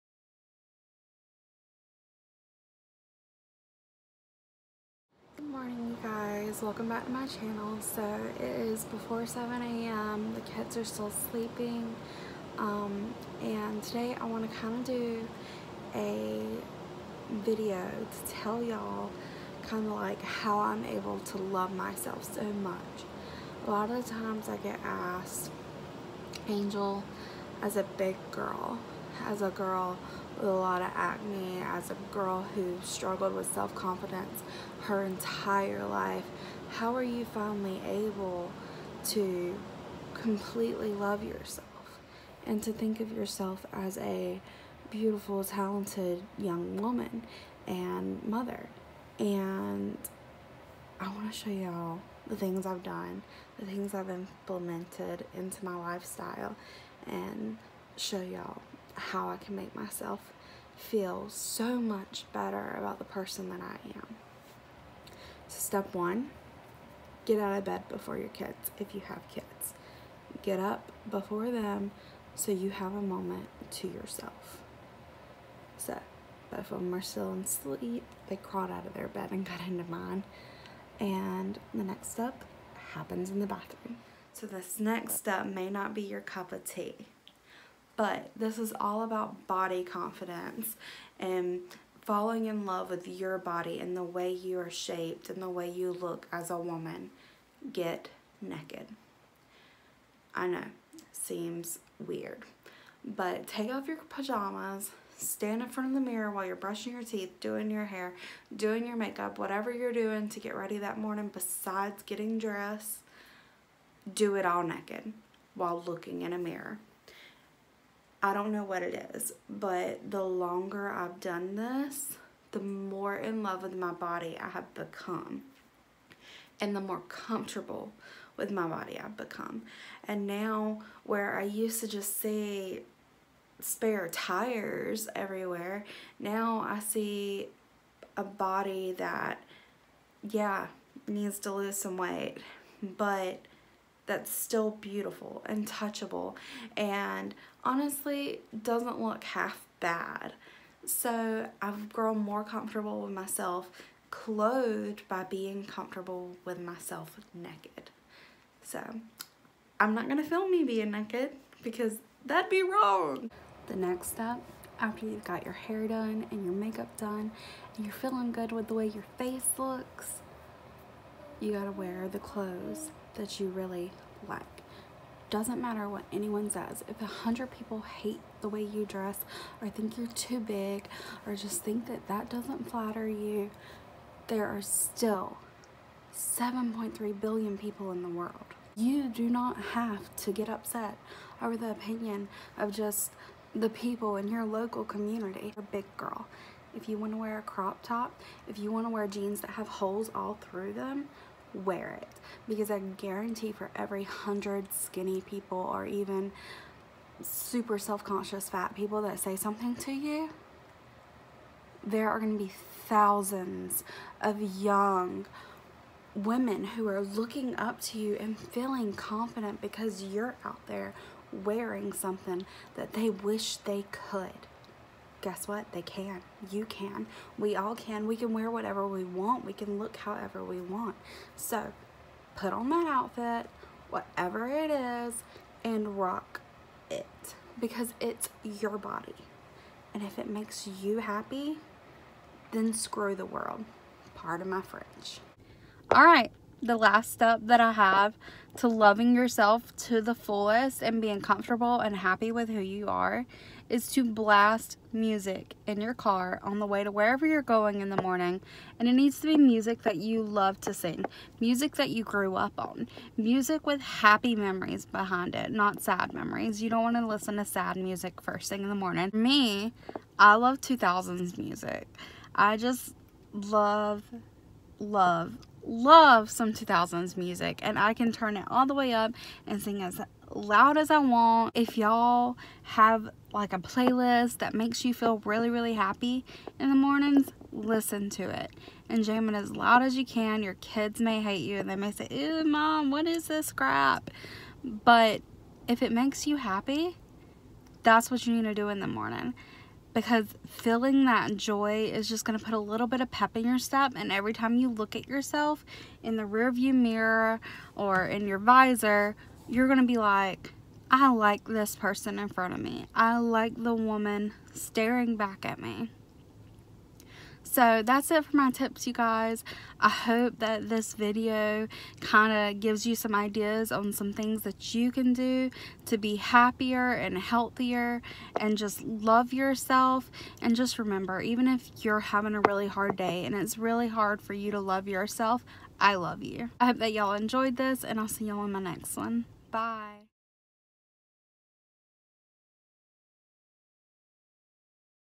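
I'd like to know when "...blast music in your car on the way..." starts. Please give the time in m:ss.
4:14.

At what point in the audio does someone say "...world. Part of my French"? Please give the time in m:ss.
4:03.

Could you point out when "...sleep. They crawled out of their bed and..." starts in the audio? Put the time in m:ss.
1:17.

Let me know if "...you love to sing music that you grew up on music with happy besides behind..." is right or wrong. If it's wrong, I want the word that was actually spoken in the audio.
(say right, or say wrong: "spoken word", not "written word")
wrong: "memories", not "besides".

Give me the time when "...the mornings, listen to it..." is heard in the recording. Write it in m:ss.
4:46.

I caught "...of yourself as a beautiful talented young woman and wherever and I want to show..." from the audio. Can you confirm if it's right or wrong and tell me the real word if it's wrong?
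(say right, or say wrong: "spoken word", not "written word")
wrong: "mother", not "wherever".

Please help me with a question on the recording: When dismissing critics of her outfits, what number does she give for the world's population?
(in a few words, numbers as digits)
7.3 billion.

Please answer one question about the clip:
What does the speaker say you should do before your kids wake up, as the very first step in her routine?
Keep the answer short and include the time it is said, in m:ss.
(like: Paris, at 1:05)
Get out of bed, at 1:07.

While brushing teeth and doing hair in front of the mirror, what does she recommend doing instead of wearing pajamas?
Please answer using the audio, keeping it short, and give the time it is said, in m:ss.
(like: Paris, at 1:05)
Get naked, at 1:37.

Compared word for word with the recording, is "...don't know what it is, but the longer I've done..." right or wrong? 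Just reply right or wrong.
right.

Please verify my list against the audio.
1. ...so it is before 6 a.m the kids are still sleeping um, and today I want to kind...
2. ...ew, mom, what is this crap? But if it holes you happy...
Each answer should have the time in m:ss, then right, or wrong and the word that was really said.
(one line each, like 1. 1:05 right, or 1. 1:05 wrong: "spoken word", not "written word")
1. 0:07 wrong: "7", not "6"
2. 4:52 wrong: "makes", not "holes".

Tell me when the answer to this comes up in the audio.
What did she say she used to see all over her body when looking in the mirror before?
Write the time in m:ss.
2:13.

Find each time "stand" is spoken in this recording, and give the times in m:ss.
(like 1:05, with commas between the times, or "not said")
1:45.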